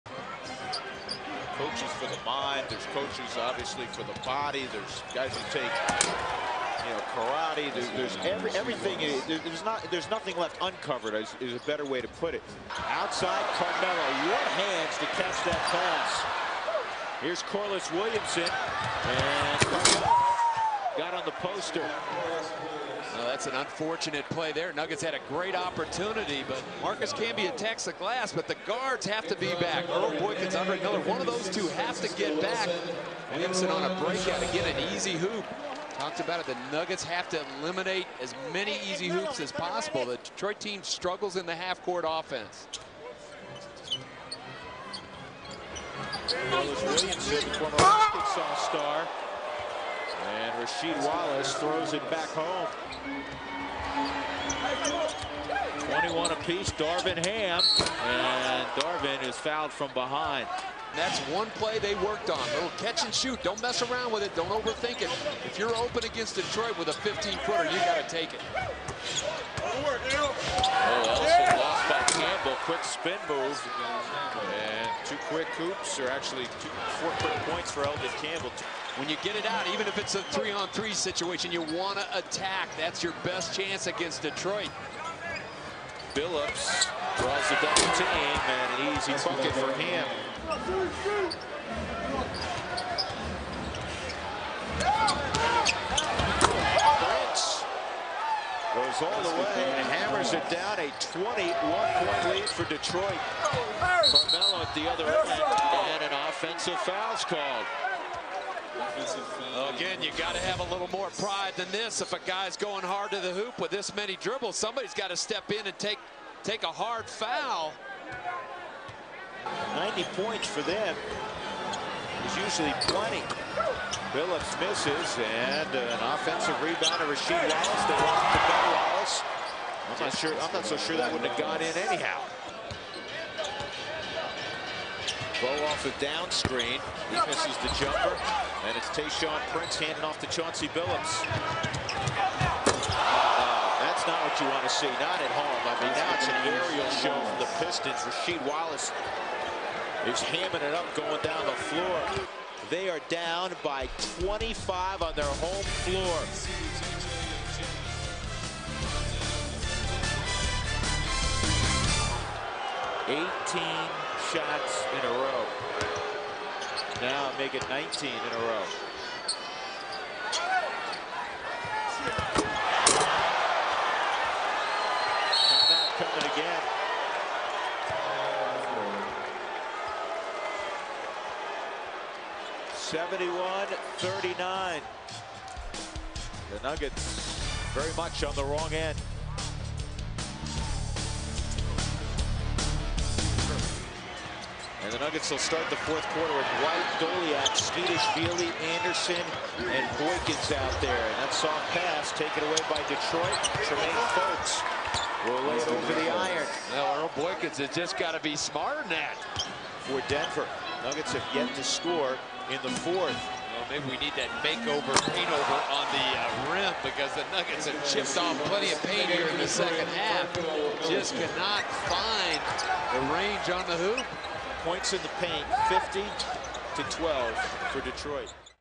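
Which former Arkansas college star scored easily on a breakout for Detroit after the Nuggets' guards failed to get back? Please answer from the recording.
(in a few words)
Corliss Williamson.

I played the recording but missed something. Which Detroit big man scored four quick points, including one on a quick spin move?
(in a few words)
Elden Campbell.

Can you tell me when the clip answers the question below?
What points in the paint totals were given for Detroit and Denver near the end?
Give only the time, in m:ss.
3:45.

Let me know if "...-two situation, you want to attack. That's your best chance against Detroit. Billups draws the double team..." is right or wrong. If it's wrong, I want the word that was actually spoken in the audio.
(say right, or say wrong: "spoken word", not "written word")
wrong: "three", not "two".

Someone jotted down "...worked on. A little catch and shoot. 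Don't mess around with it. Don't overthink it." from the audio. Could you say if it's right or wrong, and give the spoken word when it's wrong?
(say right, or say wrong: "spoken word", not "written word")
right.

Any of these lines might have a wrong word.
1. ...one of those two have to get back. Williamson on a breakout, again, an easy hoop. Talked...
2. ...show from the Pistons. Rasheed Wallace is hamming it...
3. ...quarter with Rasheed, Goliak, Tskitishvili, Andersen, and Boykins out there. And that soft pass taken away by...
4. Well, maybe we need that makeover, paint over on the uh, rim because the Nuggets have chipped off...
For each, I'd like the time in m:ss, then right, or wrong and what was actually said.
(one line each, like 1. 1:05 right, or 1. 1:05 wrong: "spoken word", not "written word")
1. 0:31 right
2. 2:26 right
3. 3:16 wrong: "White", not "Rasheed"
4. 3:33 right.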